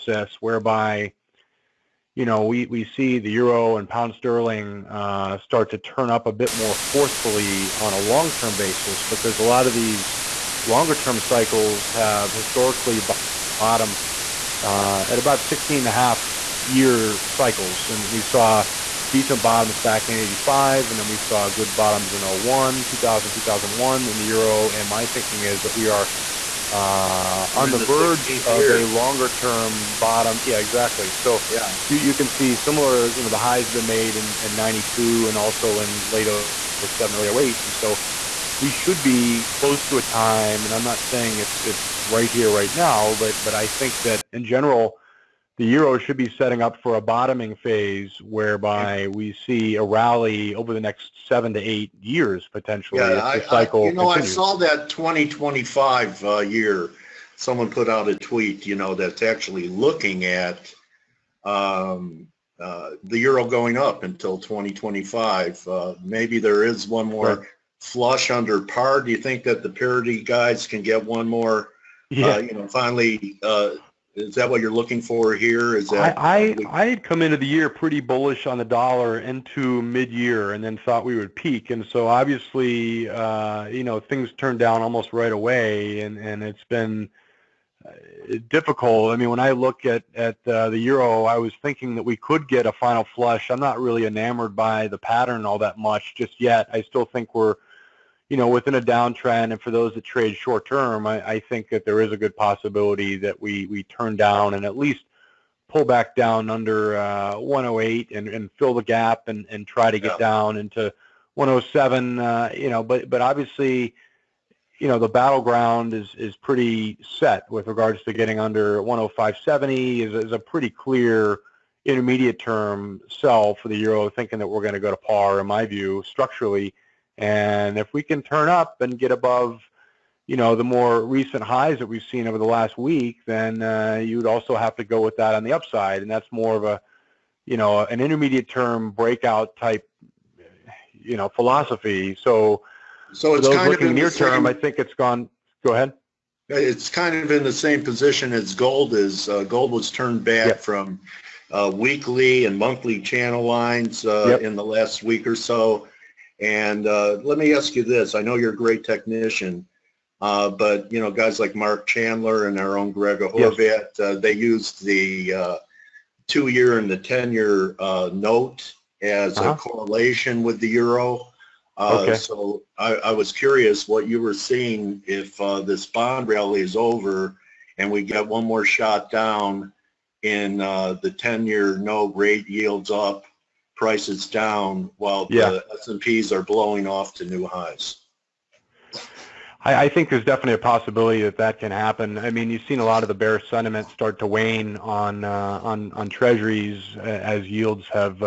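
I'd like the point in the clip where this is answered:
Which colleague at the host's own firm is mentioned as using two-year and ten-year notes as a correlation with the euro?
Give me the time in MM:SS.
02:42.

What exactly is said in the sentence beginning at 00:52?
Yeah, I, cycle I, you know, continues.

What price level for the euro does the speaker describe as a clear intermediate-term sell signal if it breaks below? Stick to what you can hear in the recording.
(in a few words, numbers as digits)
105.70.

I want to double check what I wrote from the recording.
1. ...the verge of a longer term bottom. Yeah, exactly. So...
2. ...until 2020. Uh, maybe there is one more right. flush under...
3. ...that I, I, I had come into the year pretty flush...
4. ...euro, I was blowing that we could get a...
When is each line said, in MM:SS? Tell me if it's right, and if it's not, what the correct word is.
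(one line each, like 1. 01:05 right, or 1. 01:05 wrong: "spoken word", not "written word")
1. 00:27 right
2. 01:04 wrong: "2025", not "2020"
3. 01:15 wrong: "bullish", not "flush"
4. 01:30 wrong: "thinking", not "blowing".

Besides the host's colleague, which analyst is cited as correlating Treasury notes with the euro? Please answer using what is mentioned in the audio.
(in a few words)
Mark Chandler.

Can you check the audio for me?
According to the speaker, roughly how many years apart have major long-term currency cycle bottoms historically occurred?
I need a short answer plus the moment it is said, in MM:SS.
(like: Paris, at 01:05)
16.5 years, at 00:15.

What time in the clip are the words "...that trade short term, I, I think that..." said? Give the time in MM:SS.
01:39.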